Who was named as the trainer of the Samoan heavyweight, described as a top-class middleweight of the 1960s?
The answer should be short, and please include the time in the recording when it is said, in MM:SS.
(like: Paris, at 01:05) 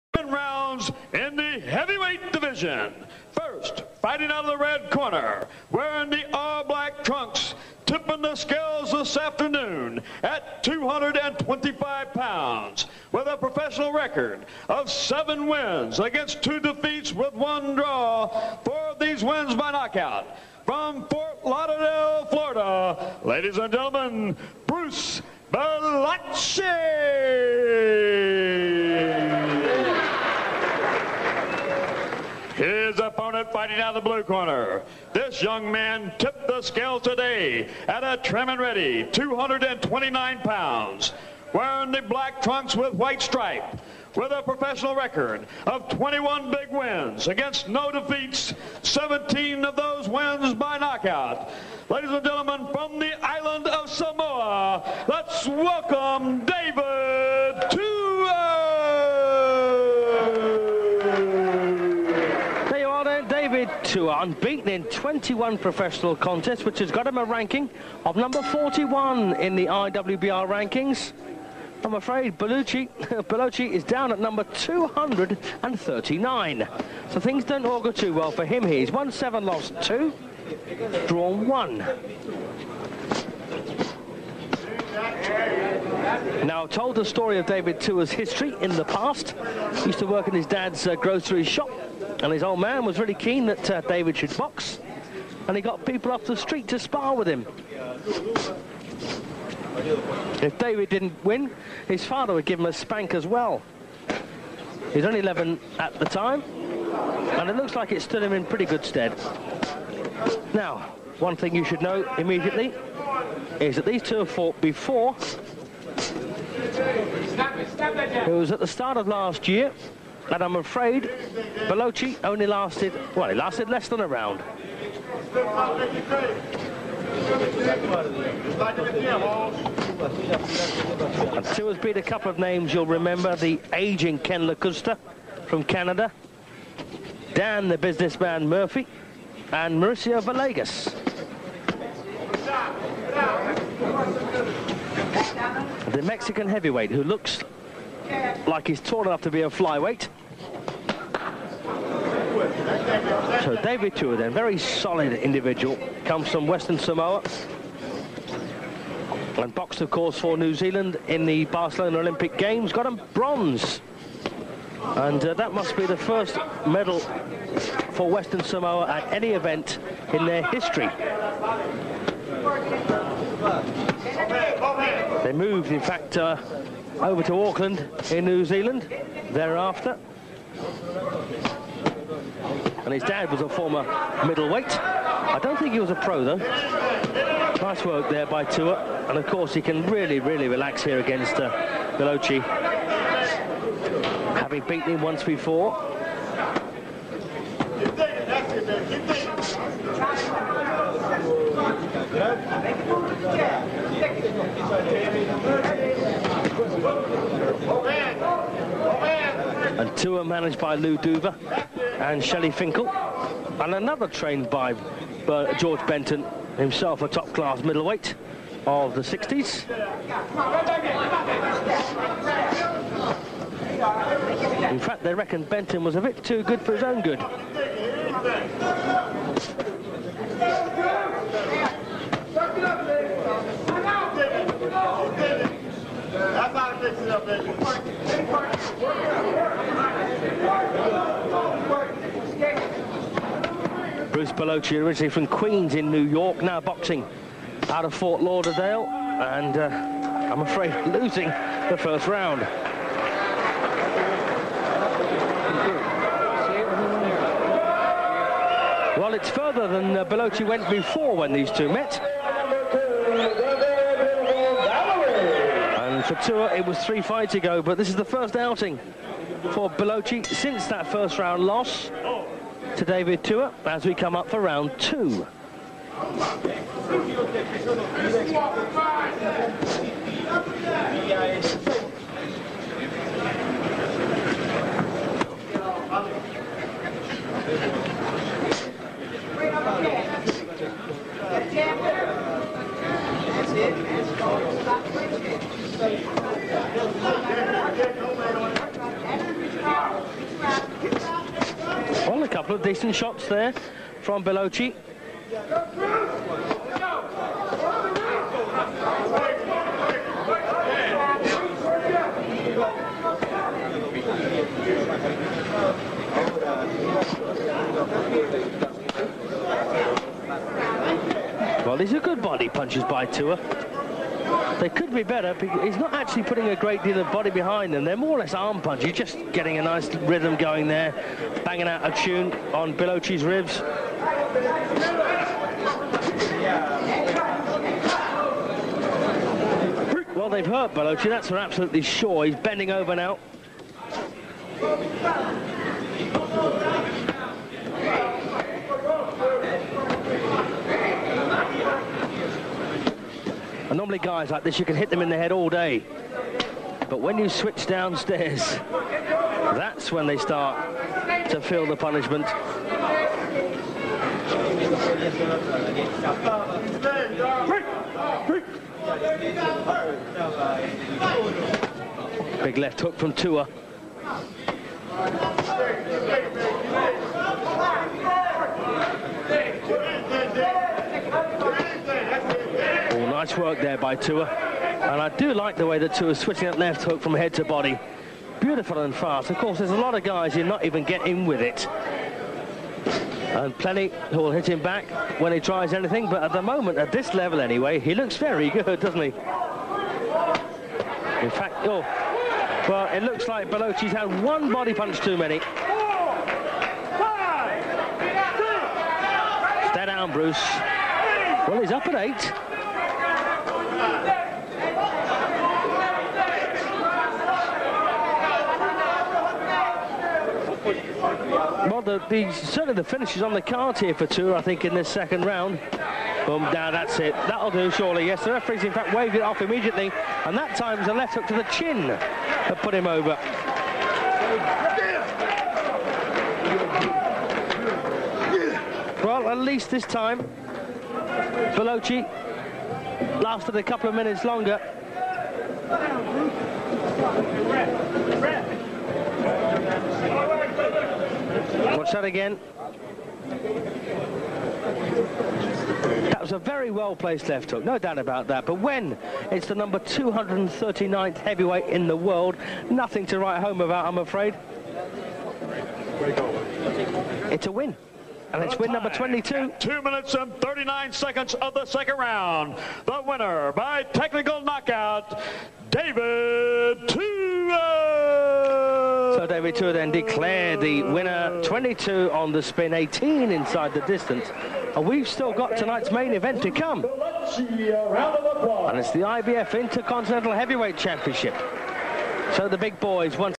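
George Benton, at 03:35.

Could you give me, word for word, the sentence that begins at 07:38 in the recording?
But when it's the number 239th heavyweight in the world, nothing to write home about, I'm afraid.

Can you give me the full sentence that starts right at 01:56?
It was at the start of last year, and I'm afraid Bellocchi only lasted, well, he lasted less than a round.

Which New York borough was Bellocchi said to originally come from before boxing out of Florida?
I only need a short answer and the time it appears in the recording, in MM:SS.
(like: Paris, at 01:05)
Queens, at 04:05.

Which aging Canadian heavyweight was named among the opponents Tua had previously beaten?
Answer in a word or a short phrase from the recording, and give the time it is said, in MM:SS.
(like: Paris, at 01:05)
Ken Lakusta, at 02:14.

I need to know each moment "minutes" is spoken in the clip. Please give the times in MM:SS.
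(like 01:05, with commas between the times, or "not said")
07:23, 07:49.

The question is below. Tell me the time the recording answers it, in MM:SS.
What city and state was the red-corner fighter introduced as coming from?
00:21.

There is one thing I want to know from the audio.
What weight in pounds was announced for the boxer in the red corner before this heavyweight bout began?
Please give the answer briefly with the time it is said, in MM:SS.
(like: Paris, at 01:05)
225, at 00:10.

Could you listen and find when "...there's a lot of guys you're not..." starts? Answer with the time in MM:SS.
06:29.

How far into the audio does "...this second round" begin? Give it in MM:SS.
07:04.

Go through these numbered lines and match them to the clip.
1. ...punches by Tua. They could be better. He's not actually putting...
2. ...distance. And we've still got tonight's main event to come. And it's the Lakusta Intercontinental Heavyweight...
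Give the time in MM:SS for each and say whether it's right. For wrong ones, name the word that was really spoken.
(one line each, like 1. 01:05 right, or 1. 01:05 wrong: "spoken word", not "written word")
1. 05:22 right
2. 08:03 wrong: "IBF", not "Lakusta".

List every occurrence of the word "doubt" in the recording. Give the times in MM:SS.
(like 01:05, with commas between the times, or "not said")
07:37.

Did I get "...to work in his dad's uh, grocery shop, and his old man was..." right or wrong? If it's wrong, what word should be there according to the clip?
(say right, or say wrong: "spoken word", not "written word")
right.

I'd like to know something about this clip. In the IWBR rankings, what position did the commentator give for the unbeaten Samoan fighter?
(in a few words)
41.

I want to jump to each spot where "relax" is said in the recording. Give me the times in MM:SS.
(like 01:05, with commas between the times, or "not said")
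03:10.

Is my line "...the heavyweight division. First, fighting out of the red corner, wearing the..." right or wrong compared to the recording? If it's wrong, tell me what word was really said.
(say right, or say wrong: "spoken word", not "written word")
right.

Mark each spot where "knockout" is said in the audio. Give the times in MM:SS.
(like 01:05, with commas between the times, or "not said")
00:19, 00:50, 07:54.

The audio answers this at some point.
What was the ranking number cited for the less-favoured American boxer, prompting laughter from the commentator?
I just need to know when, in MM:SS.
01:14.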